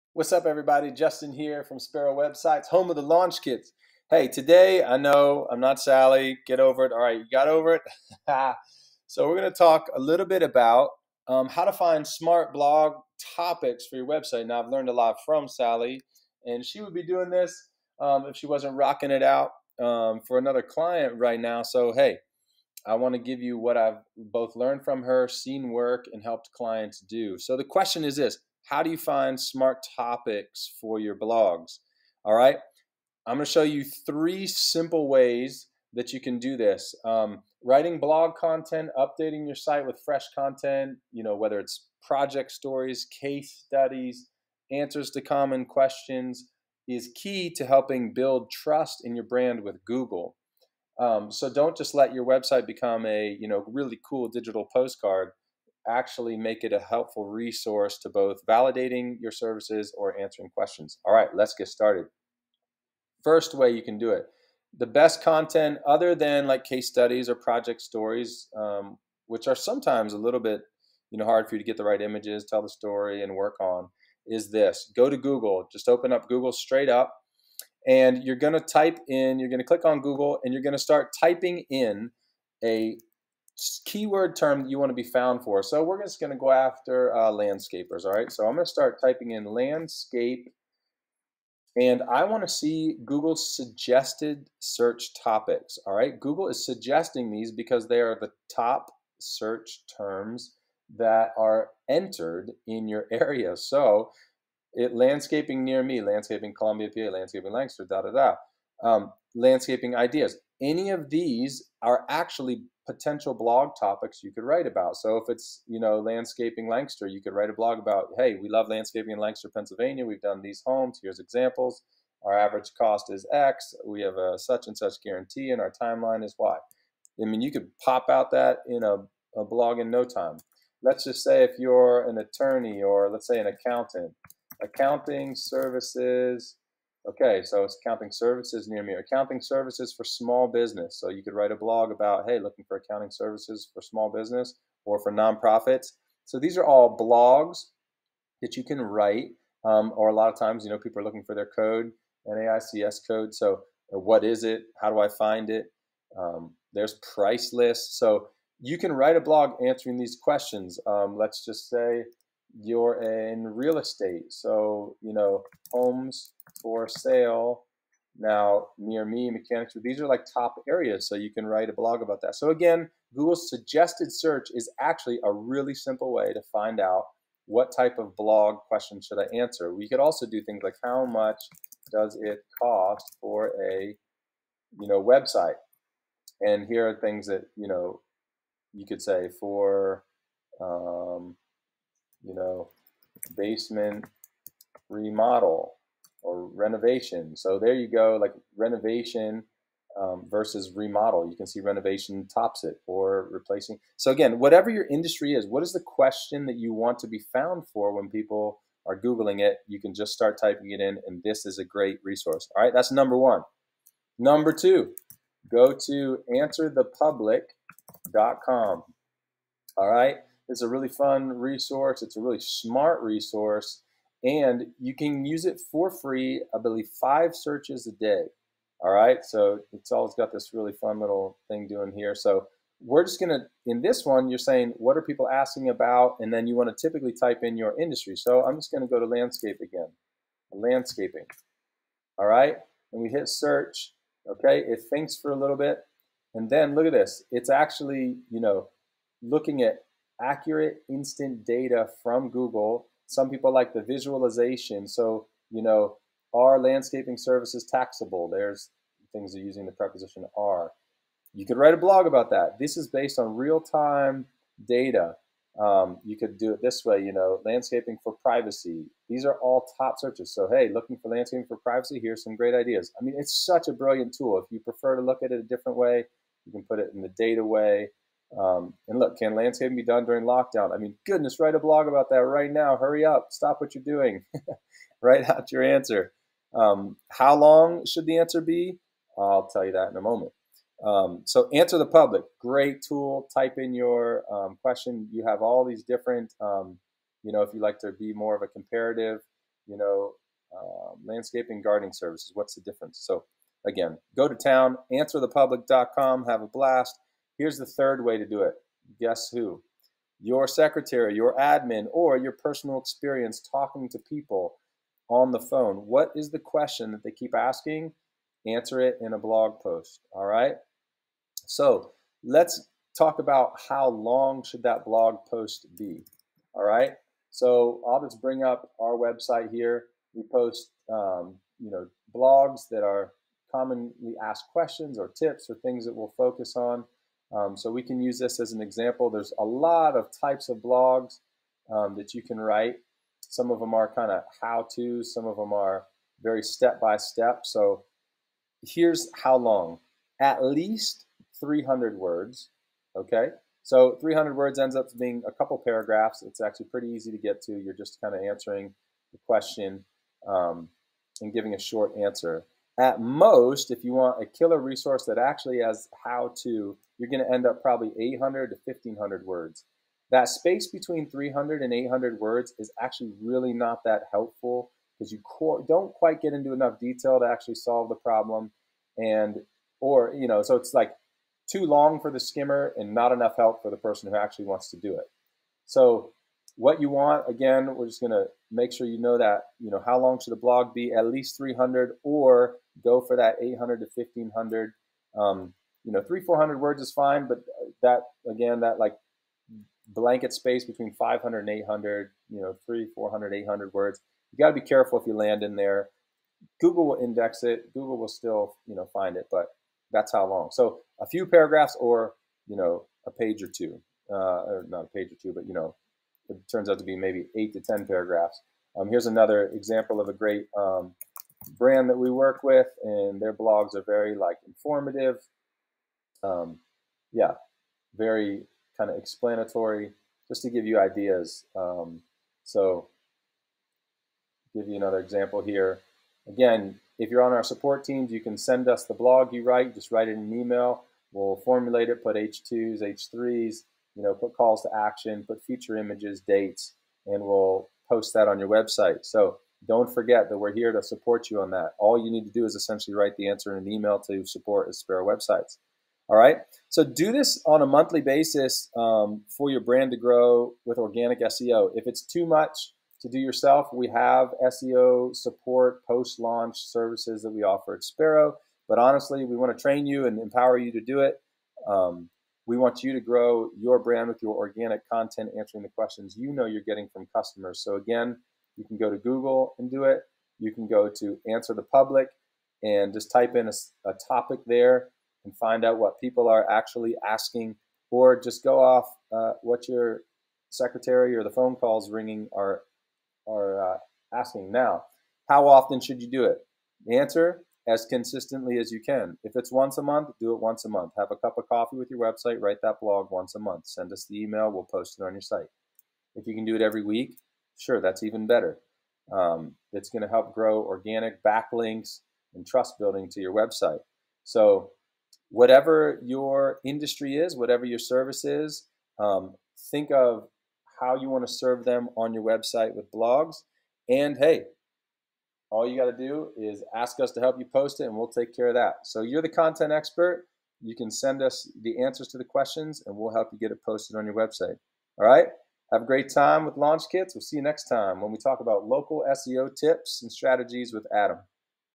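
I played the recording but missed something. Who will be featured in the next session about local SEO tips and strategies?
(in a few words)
Adam.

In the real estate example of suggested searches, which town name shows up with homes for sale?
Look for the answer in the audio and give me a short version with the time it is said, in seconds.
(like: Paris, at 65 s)
Mechanicsburg, at 169 s.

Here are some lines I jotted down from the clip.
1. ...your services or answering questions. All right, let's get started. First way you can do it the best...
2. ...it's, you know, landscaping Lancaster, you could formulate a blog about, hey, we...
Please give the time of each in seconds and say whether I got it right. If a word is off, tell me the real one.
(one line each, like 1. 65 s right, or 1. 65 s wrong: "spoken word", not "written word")
1. 59 s right
2. 115 s wrong: "write", not "formulate".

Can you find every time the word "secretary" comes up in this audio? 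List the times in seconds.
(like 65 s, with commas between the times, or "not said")
310 s, 490 s.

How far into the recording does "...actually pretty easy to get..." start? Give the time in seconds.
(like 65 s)
356 s.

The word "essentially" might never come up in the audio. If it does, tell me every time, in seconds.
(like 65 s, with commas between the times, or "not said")
452 s.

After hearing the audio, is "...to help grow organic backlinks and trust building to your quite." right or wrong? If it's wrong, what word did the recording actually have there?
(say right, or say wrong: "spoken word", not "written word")
wrong: "website", not "quite".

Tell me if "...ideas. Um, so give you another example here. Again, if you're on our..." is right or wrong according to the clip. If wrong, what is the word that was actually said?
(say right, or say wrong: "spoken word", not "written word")
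right.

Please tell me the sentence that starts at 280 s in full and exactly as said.
I mean, goodness, write a blog about that right now.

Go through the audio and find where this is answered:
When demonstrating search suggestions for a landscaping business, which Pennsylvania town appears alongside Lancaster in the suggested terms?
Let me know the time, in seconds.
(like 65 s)
106 s.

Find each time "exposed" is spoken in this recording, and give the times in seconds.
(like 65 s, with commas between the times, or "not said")
not said.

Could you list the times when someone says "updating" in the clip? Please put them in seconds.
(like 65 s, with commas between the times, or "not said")
38 s.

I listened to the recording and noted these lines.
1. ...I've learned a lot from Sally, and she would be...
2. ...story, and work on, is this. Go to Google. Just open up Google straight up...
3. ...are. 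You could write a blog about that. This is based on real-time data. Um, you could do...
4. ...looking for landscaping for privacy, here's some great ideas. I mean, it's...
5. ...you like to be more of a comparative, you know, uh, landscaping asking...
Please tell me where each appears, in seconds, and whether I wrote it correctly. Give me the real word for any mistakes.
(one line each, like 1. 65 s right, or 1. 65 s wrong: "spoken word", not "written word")
1. 14 s right
2. 72 s right
3. 260 s right
4. 270 s right
5. 297 s wrong: "gardening", not "asking".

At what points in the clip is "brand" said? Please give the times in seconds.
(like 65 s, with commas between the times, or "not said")
49 s, 421 s, 459 s, 473 s.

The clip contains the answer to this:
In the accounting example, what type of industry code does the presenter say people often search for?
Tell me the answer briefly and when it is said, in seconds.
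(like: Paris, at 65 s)
NAICS code, at 152 s.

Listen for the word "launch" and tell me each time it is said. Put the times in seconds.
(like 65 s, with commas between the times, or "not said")
3 s, 466 s, 536 s.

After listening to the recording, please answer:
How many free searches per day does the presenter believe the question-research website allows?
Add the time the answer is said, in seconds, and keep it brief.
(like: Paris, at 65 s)
5, at 226 s.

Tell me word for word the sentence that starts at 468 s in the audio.
But honestly, we want to train you and empower you to do it.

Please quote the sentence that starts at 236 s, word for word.
And then you wanna typically type in your industry.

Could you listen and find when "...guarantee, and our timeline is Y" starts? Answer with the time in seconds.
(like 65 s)
125 s.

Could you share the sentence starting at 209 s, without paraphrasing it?
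You can just start typing it in, and this is a great resource.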